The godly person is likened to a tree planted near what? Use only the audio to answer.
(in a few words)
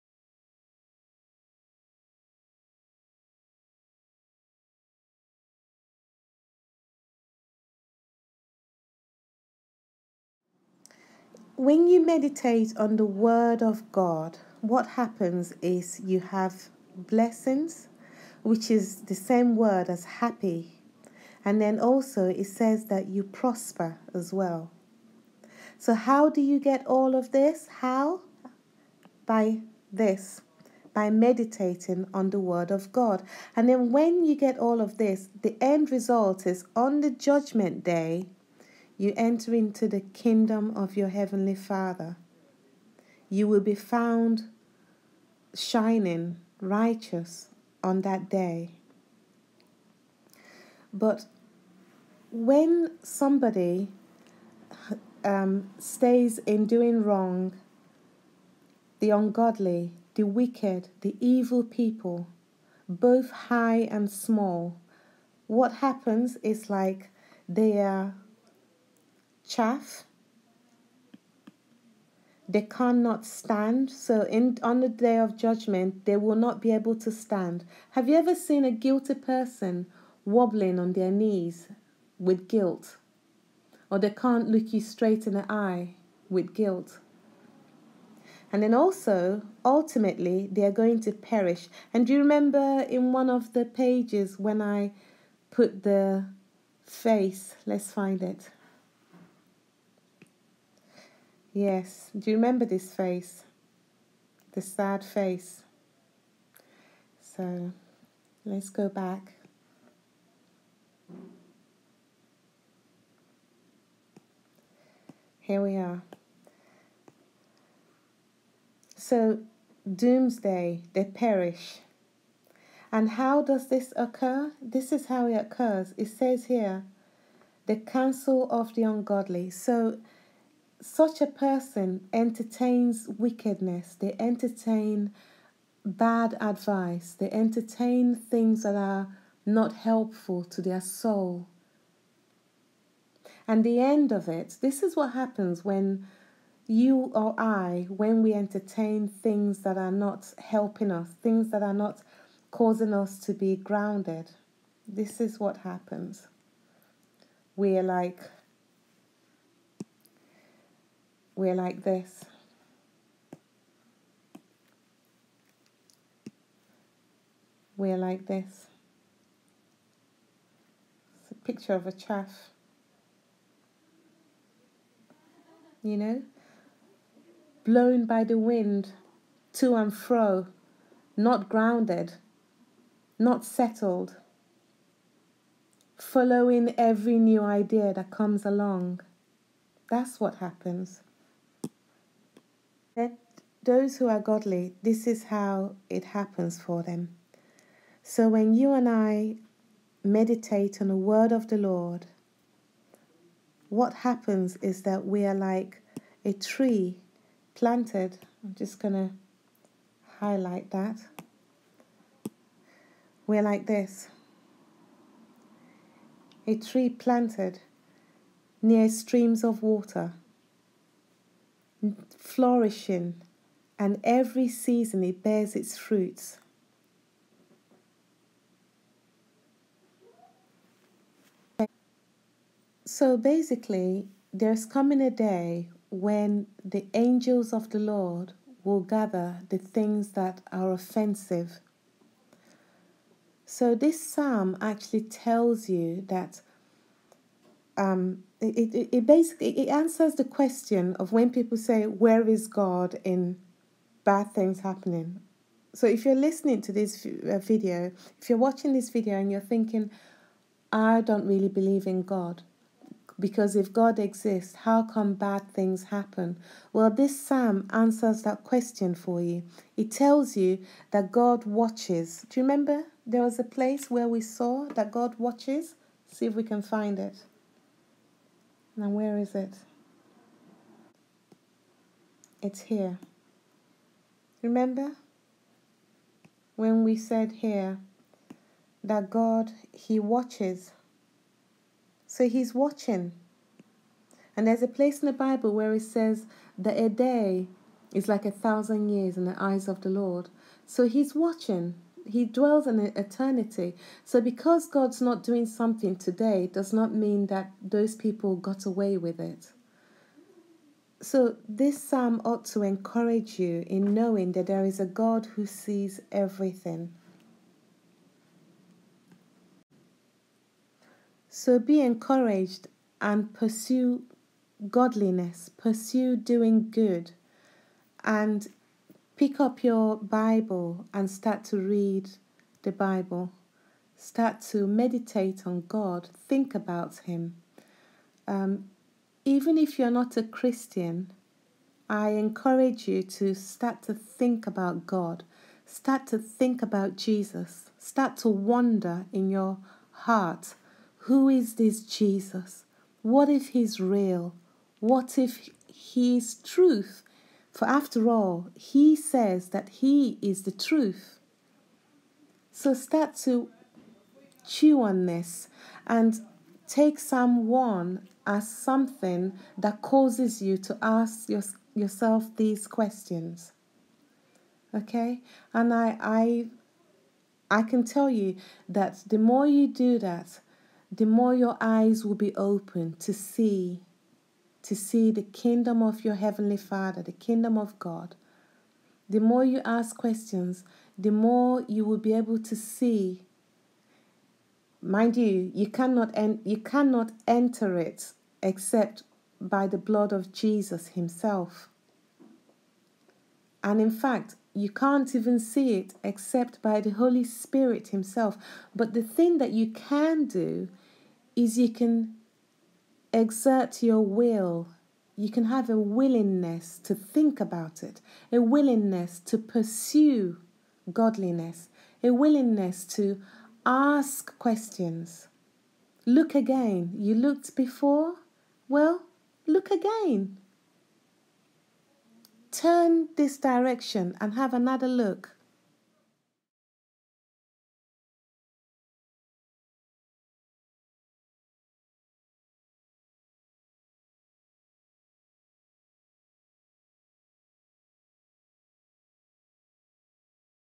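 streams of water.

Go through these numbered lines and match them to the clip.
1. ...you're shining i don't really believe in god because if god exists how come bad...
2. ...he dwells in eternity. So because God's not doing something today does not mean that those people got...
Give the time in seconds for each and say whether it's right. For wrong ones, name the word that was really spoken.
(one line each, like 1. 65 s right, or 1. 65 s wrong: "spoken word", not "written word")
1. 259 s wrong: "thinking", not "shining"
2. 302 s right.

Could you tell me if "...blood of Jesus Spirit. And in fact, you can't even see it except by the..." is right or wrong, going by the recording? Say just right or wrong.
wrong.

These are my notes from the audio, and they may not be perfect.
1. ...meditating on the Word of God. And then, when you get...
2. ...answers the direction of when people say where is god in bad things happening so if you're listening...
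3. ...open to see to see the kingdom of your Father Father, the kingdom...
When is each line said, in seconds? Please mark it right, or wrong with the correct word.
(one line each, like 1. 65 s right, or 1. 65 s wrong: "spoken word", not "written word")
1. 31 s right
2. 249 s wrong: "question", not "direction"
3. 382 s wrong: "Heavenly", not "Father".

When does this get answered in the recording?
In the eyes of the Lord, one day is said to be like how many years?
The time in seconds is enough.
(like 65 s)
298 s.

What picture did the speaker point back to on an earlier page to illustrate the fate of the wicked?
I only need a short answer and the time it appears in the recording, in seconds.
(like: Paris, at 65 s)
The sad face, at 104 s.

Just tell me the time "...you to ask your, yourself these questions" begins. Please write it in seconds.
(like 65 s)
370 s.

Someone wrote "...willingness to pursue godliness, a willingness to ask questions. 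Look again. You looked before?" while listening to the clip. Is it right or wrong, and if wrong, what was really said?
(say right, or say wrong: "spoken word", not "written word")
right.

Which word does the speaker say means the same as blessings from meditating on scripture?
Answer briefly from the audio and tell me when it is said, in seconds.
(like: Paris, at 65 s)
happy, at 20 s.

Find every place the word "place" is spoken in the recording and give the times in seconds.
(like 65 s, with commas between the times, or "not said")
273 s, 294 s.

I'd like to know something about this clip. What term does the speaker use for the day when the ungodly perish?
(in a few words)
doomsday.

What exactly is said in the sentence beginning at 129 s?
So, such a person entertains wickedness, they entertain bad advice, they entertain things that are not helpful to their soul.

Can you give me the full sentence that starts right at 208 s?
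I'm just going to highlight that.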